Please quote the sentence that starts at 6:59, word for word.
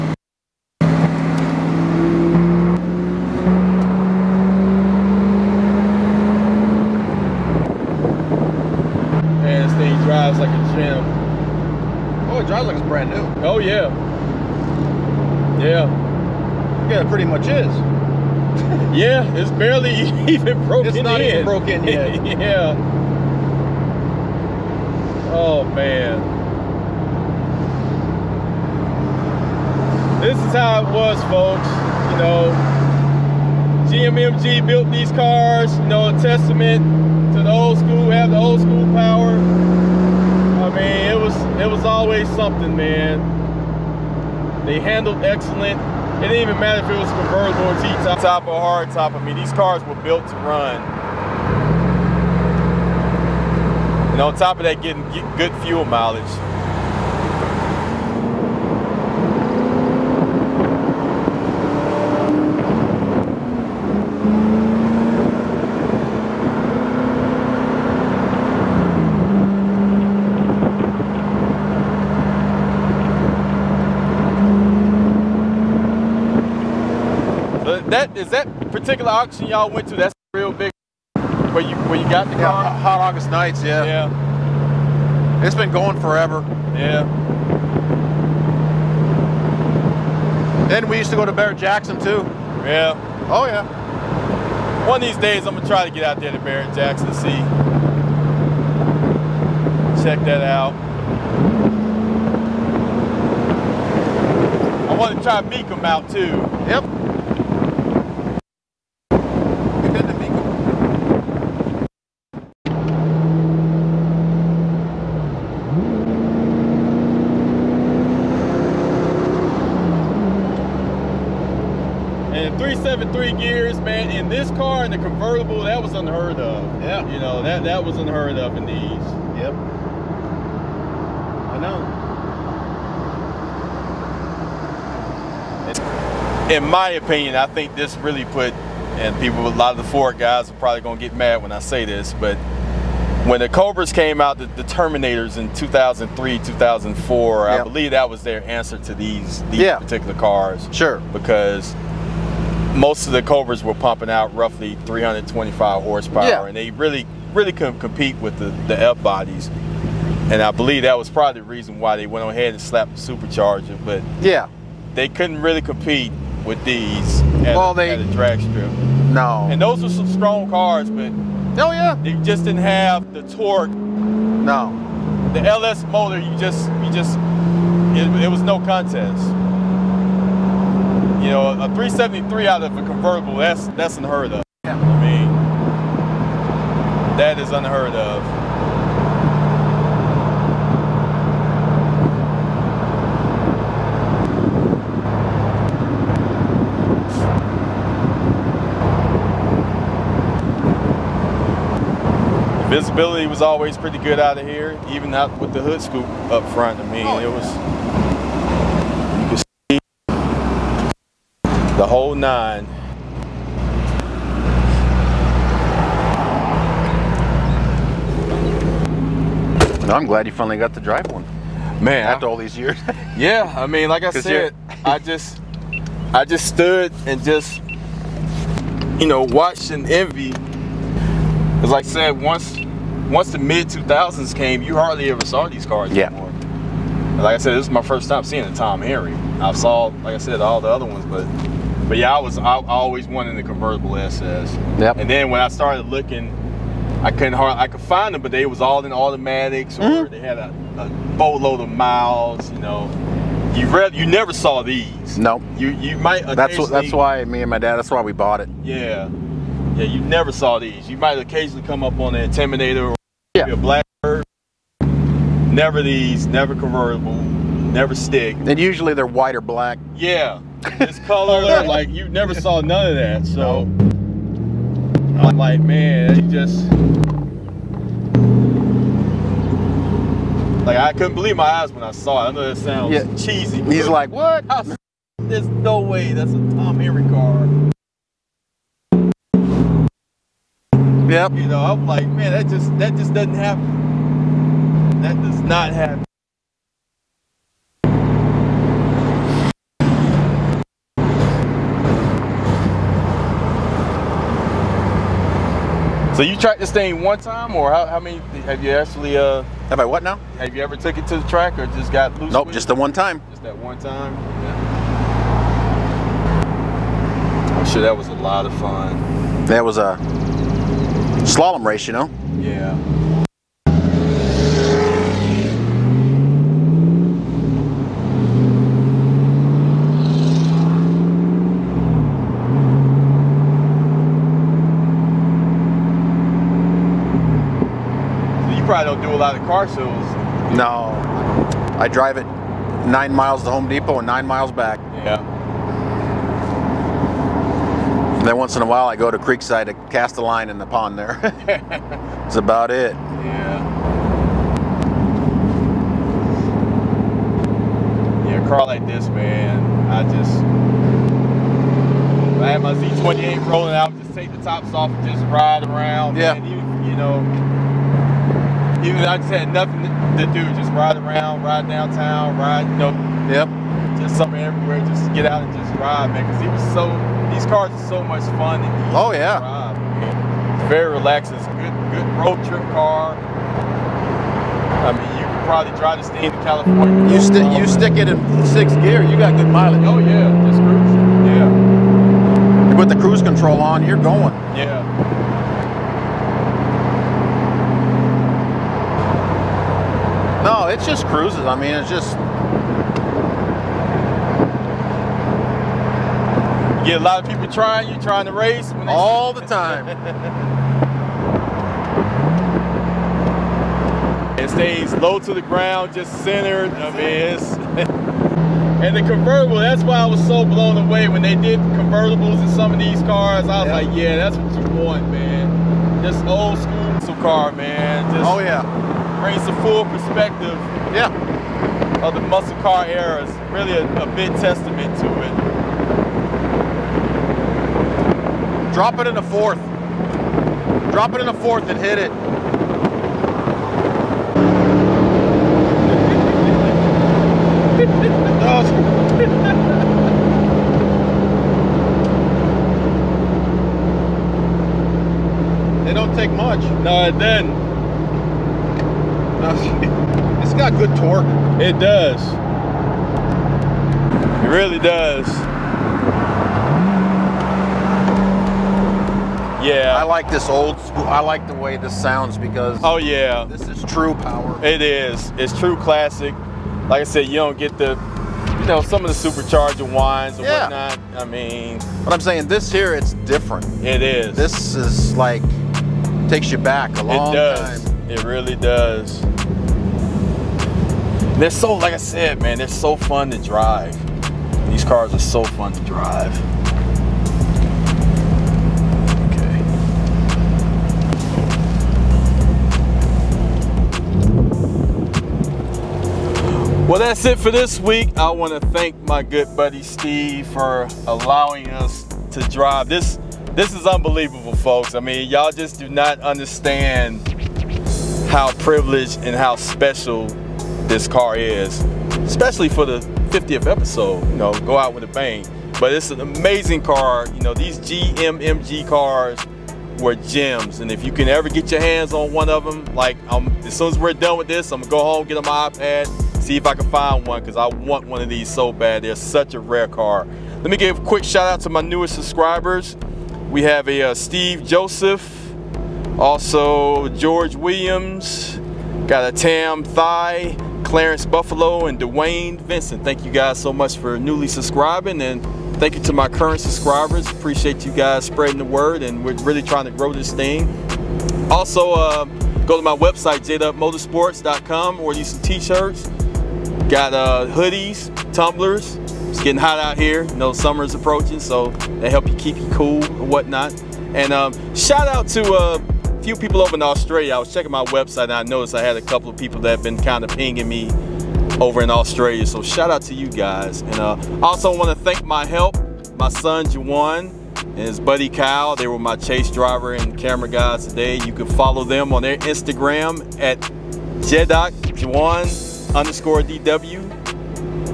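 That's why I was so blown away when they did convertibles in some of these cars.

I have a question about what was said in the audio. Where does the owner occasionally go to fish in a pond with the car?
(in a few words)
Creekside.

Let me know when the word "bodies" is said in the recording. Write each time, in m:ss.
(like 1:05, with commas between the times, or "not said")
2:39.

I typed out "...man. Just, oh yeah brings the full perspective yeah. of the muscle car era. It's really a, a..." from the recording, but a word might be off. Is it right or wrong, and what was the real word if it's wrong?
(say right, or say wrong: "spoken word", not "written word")
right.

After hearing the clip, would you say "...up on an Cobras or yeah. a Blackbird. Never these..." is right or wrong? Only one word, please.
wrong.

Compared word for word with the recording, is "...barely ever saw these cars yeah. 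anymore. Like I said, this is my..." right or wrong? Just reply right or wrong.
wrong.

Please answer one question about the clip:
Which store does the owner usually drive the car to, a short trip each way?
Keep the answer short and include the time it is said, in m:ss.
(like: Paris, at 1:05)
Home Depot, at 5:43.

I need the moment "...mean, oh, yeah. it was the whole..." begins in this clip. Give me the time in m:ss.
3:26.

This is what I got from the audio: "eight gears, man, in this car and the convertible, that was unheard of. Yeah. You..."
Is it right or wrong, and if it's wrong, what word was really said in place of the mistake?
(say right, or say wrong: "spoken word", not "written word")
wrong: "three", not "eight".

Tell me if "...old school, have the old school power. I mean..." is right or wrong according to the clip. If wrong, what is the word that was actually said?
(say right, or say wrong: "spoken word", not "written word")
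right.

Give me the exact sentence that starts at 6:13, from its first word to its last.
just something everywhere, just get out and just ride, man.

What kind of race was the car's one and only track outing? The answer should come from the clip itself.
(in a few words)
Slalom race.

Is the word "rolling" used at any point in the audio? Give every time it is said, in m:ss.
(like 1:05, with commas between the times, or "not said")
6:03.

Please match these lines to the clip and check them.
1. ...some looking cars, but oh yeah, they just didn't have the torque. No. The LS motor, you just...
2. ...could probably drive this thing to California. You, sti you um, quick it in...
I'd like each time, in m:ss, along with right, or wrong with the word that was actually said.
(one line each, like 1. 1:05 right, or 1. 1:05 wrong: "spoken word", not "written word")
1. 2:49 wrong: "strong", not "looking"
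2. 6:25 wrong: "stick", not "quick".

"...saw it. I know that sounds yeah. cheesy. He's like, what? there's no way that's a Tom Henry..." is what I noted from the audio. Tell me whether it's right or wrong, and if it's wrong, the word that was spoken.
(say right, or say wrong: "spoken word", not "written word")
right.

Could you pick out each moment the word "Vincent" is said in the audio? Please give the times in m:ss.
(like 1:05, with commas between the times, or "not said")
9:12.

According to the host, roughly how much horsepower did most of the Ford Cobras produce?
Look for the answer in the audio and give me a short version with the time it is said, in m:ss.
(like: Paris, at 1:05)
325, at 2:34.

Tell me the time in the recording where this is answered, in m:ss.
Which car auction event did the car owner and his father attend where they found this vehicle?
1:22.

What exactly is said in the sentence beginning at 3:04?
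I mean, that is unheard of.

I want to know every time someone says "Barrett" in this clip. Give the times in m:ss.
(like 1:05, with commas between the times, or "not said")
1:31, 1:36.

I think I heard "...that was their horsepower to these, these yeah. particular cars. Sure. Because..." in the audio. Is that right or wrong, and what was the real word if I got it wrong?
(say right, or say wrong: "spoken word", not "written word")
wrong: "answer", not "horsepower".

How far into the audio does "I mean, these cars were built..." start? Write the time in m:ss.
0:49.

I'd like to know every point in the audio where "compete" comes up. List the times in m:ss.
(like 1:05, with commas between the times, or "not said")
2:37, 2:45.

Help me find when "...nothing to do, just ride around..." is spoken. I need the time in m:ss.
6:09.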